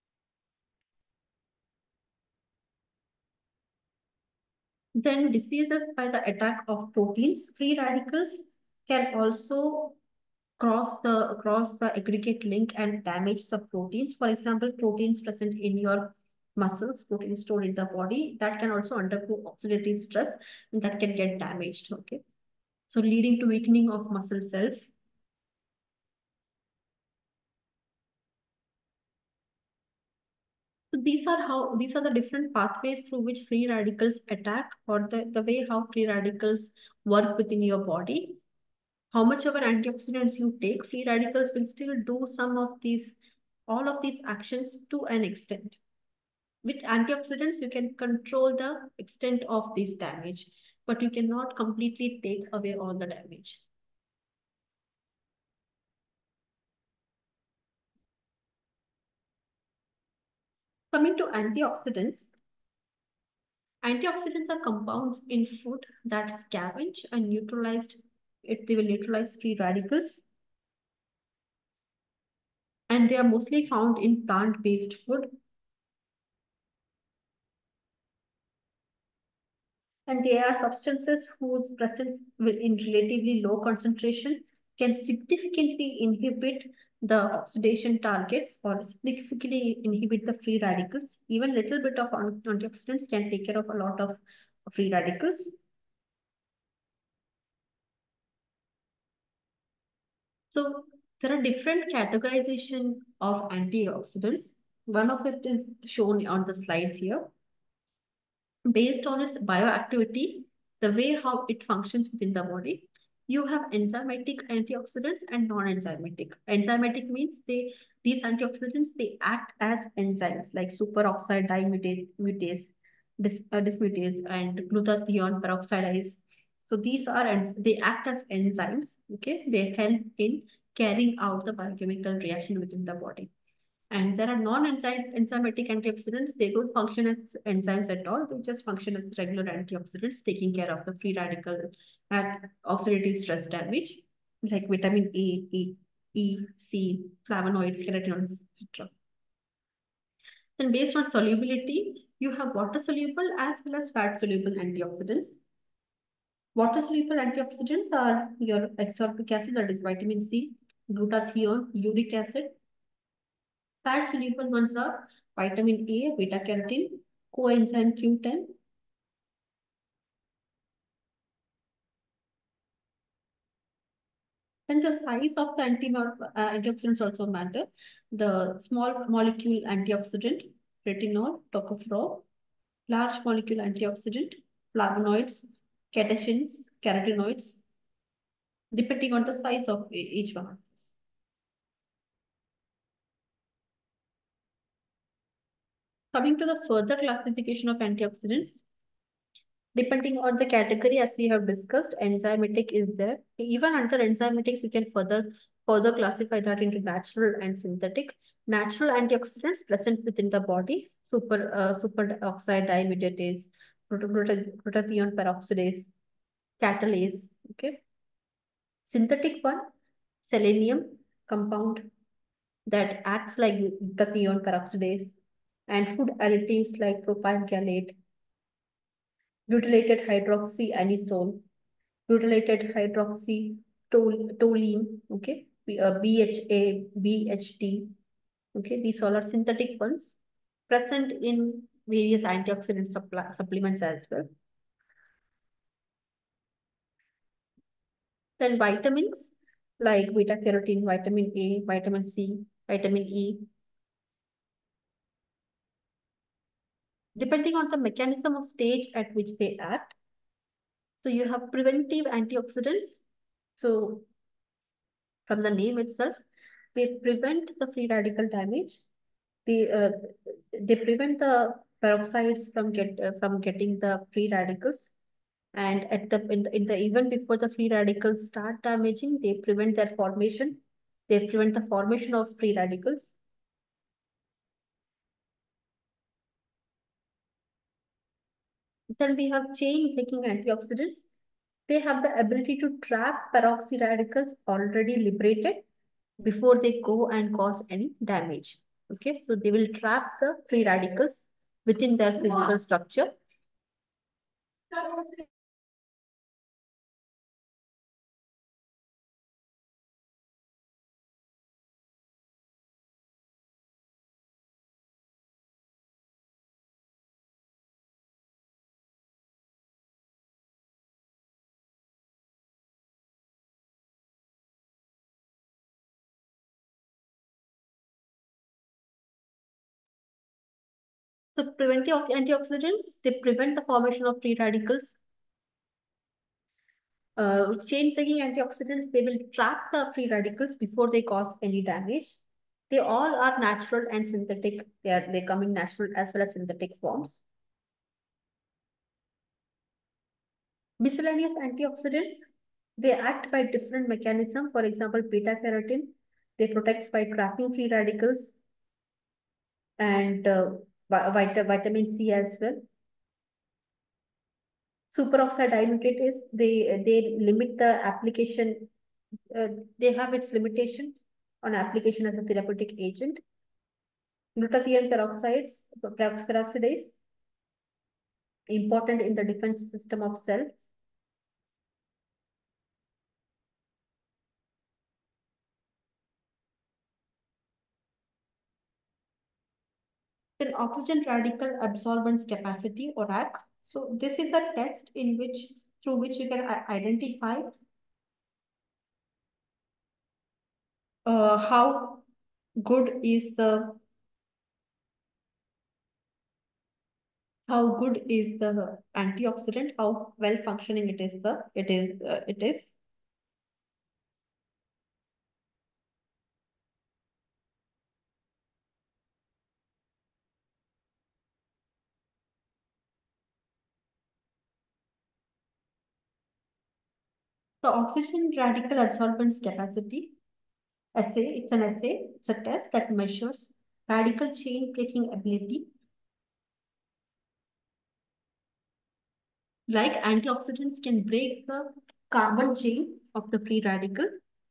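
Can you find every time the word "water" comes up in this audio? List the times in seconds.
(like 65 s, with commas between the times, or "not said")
152 s, 156 s.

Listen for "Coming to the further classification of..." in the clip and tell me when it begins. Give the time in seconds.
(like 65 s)
196 s.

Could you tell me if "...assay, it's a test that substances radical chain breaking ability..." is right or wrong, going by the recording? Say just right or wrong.
wrong.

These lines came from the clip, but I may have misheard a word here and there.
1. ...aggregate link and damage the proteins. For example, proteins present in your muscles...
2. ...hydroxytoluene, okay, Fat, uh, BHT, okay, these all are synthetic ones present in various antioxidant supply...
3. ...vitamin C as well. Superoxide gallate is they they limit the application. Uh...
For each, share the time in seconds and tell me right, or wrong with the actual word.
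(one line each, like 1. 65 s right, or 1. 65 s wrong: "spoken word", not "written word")
1. 11 s right
2. 232 s wrong: "BHA", not "Fat"
3. 360 s wrong: "dilutate", not "gallate".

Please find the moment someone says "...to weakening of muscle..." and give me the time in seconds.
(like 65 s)
23 s.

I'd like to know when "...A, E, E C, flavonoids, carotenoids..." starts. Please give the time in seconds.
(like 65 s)
145 s.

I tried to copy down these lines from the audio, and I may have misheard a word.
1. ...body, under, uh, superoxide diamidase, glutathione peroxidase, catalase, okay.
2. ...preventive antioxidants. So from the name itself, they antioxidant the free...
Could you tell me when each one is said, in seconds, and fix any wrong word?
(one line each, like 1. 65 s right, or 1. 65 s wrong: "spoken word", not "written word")
1. 210 s wrong: "super", not "under"
2. 261 s wrong: "prevent", not "antioxidant".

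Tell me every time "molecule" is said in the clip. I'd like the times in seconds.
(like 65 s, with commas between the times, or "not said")
179 s, 183 s.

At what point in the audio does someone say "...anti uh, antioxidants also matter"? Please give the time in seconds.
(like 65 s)
175 s.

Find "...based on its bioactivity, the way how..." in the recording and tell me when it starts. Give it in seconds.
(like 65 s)
108 s.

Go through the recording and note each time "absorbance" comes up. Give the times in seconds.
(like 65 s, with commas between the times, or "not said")
391 s, 428 s.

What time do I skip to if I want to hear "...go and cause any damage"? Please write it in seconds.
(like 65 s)
296 s.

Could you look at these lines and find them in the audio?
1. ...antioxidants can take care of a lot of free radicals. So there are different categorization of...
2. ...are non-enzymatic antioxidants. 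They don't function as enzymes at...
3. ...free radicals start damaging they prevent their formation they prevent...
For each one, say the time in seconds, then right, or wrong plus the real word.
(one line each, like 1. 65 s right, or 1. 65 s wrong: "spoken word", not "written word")
1. 92 s right
2. 134 s right
3. 277 s right.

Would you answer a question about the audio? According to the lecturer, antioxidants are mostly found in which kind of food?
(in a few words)
plant-based food.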